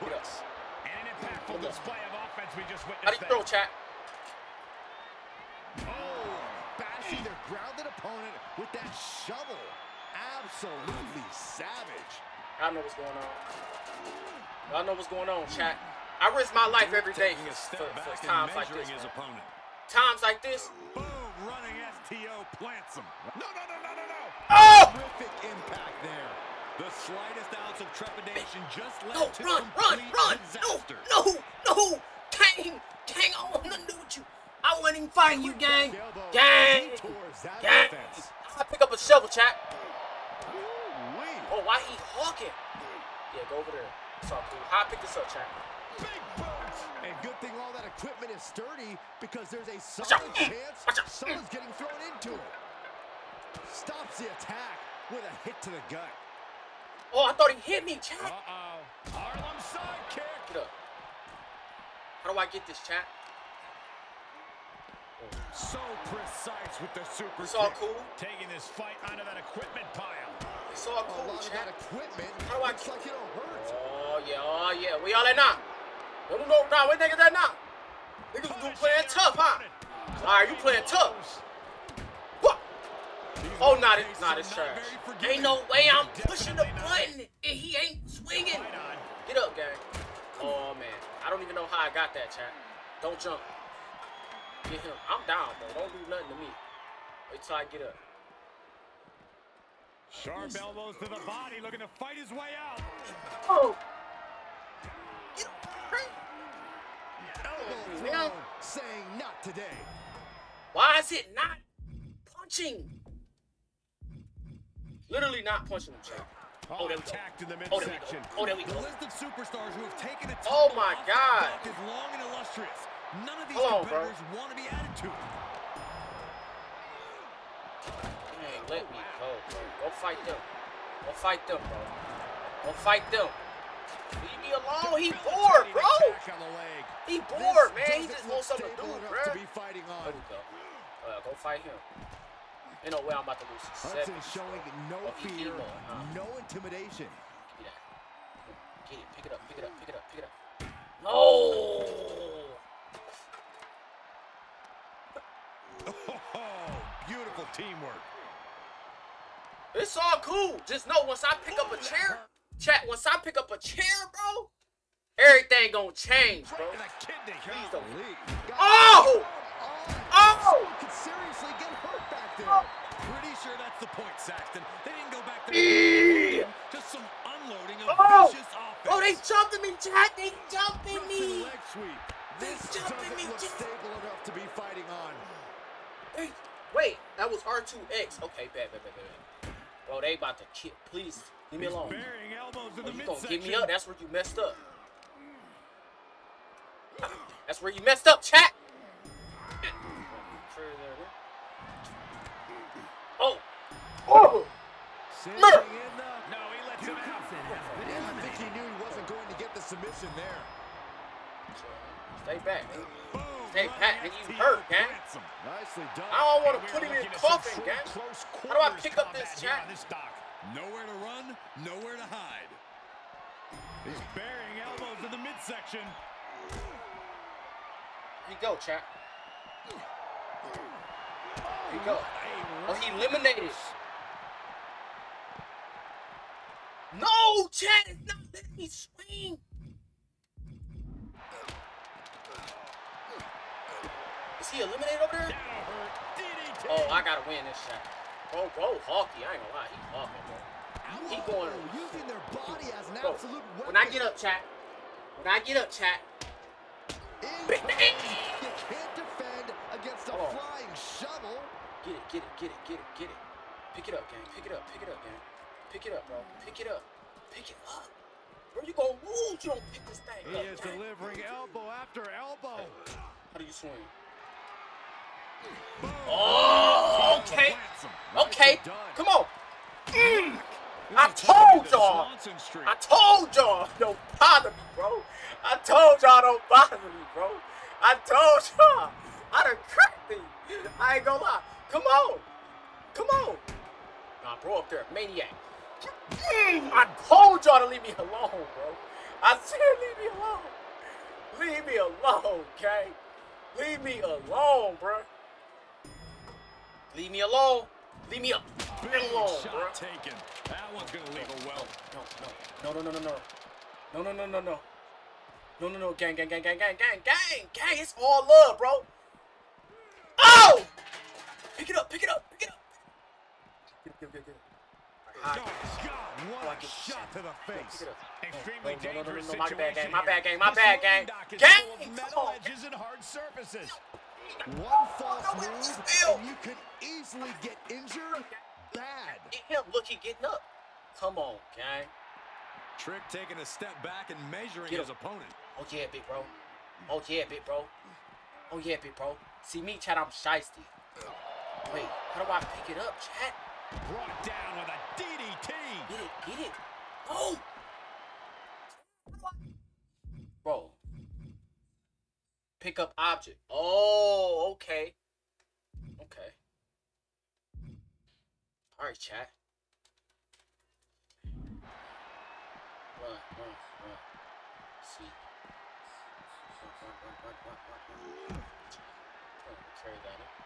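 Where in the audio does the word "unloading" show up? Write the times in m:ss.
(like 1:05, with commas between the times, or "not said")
2:57.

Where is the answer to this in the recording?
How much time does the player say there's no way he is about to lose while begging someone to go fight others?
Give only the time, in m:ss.
2:23.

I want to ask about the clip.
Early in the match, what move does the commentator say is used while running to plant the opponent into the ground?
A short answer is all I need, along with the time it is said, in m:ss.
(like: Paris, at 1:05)
STO, at 0:22.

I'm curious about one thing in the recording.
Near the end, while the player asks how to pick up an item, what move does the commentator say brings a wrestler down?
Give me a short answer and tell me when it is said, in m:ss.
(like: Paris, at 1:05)
DDT, at 5:55.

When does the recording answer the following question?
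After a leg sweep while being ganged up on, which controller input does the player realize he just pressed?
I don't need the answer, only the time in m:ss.
3:07.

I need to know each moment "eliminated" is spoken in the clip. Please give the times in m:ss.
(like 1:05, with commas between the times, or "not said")
3:52, 4:04.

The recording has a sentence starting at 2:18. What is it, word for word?
He just wants something to do, bro.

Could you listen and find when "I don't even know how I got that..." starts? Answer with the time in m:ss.
1:31.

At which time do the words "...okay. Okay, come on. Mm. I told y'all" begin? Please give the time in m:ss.
4:37.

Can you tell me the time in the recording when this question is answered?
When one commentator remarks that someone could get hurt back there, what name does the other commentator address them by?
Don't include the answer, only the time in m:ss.
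2:54.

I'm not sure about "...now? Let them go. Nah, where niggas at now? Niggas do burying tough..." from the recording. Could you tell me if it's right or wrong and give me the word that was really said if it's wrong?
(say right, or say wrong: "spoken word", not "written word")
wrong: "playing", not "burying".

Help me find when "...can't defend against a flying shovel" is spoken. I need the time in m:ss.
4:17.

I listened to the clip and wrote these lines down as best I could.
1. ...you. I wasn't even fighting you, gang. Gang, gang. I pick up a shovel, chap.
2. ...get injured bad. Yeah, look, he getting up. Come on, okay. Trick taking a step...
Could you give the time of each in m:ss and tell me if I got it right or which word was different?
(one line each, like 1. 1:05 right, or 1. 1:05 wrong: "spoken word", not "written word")
1. 0:34 right
2. 5:37 right.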